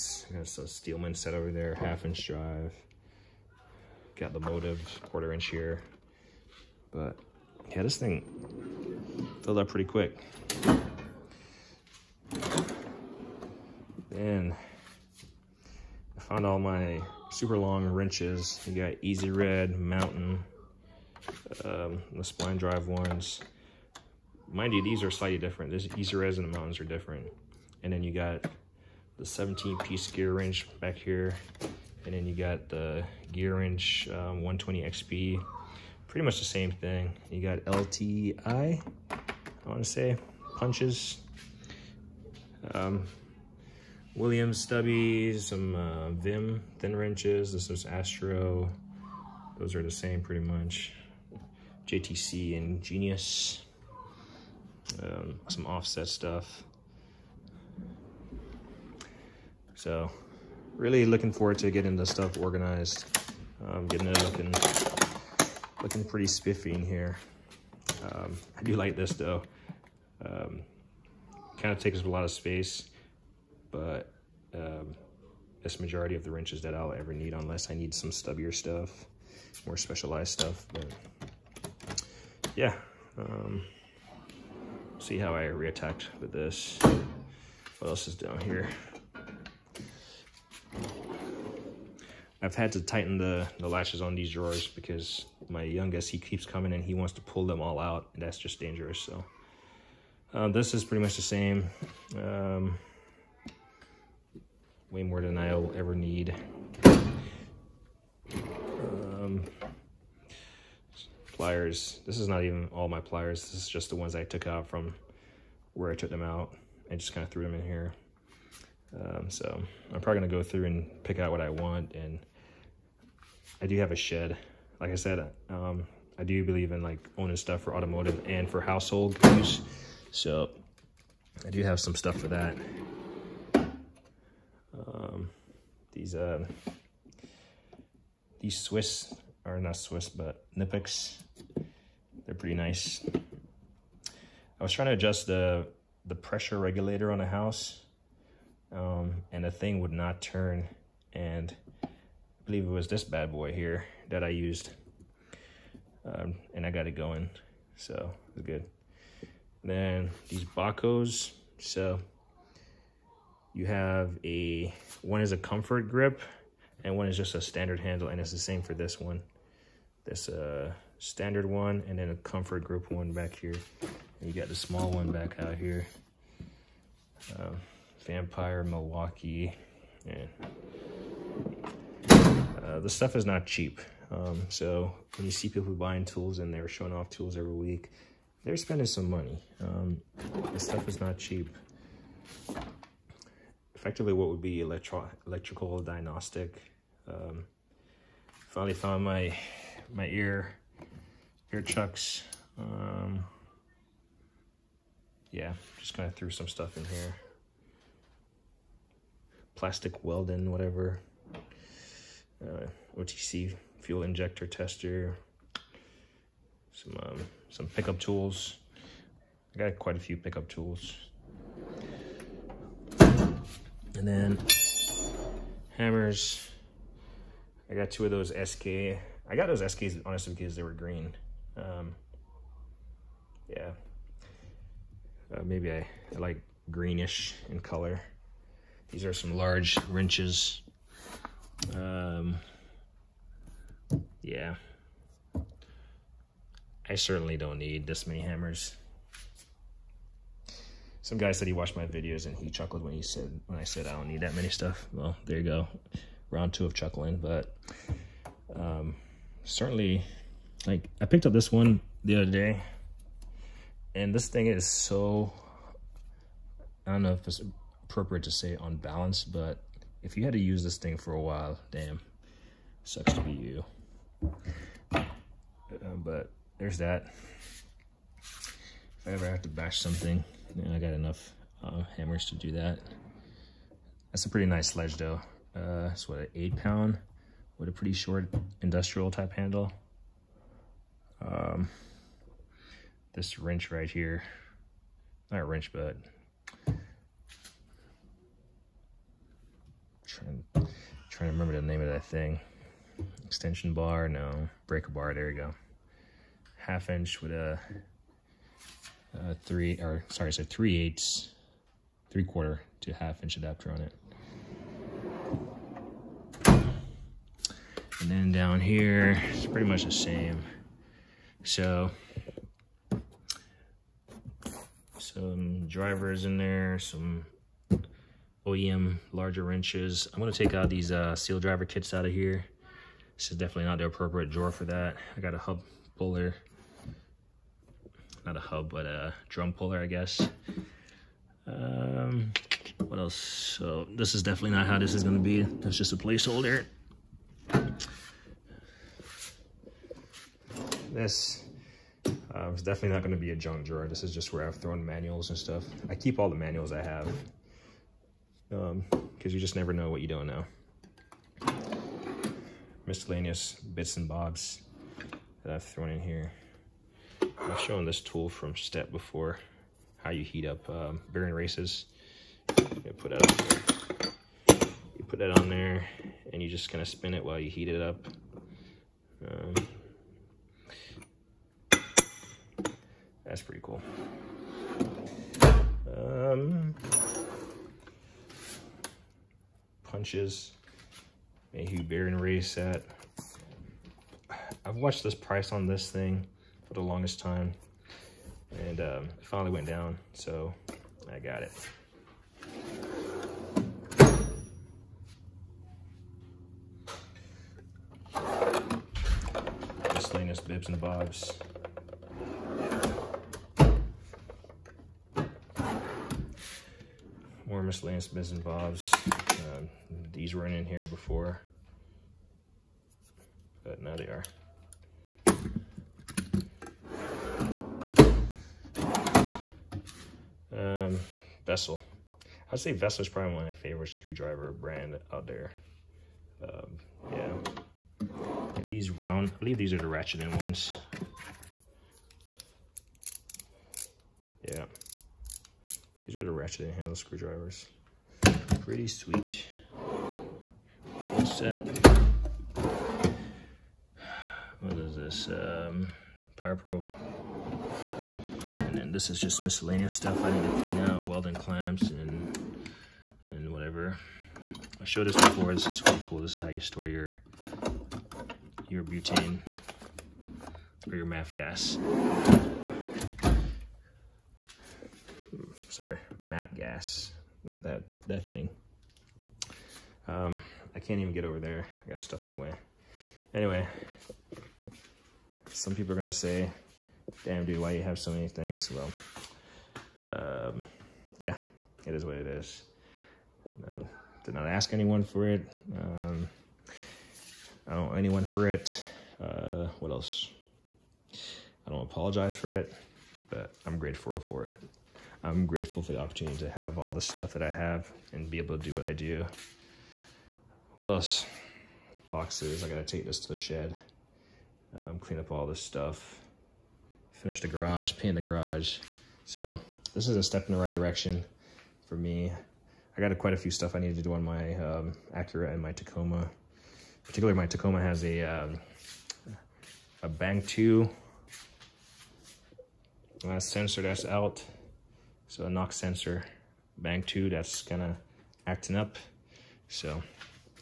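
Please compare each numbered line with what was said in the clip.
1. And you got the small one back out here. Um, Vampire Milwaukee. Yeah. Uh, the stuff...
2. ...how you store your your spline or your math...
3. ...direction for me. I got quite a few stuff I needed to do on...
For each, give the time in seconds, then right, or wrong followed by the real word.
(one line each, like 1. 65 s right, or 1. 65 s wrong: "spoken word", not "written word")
1. 174 s right
2. 466 s wrong: "butane", not "spline"
3. 520 s right.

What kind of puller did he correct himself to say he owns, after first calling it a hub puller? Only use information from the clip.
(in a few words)
Drum puller.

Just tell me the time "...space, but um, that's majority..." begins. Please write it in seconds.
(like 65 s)
72 s.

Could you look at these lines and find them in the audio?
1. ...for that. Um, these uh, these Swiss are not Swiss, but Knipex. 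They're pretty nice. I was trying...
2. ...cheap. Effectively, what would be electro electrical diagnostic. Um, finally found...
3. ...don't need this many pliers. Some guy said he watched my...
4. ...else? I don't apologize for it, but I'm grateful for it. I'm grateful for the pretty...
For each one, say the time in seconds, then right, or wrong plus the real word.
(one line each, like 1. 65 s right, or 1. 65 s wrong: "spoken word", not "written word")
1. 132 s right
2. 191 s right
3. 247 s wrong: "hammers", not "pliers"
4. 499 s wrong: "opportunity", not "pretty".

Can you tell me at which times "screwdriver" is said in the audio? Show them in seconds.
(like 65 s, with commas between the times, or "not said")
433 s, 446 s.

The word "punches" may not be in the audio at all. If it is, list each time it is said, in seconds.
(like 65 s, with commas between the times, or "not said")
40 s, 390 s.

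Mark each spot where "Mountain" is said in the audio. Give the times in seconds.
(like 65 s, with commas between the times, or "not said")
19 s, 26 s.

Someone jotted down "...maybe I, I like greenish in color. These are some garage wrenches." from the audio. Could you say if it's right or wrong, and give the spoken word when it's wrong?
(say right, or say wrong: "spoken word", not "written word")
wrong: "large", not "garage".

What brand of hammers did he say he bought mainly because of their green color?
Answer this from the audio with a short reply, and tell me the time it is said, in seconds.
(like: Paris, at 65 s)
SK, at 229 s.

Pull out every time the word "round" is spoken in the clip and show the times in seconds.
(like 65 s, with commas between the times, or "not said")
256 s, 438 s.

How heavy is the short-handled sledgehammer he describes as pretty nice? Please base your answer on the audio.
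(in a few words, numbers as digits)
8 pounds.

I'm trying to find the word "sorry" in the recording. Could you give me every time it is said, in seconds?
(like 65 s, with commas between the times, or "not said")
310 s, 475 s.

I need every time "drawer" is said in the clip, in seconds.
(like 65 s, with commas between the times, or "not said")
94 s, 334 s, 353 s.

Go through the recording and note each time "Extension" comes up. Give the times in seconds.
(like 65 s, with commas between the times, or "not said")
303 s.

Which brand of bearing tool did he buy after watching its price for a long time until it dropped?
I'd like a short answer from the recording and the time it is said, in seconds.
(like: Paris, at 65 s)
Mayhew, at 391 s.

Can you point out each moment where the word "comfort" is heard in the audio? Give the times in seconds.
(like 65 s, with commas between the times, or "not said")
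165 s, 172 s.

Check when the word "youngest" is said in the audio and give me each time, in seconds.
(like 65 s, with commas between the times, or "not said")
95 s.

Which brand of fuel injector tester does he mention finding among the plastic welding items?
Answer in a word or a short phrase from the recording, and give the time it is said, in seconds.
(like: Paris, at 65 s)
OTC, at 212 s.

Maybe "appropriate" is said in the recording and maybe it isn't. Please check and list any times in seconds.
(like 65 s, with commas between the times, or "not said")
267 s, 333 s.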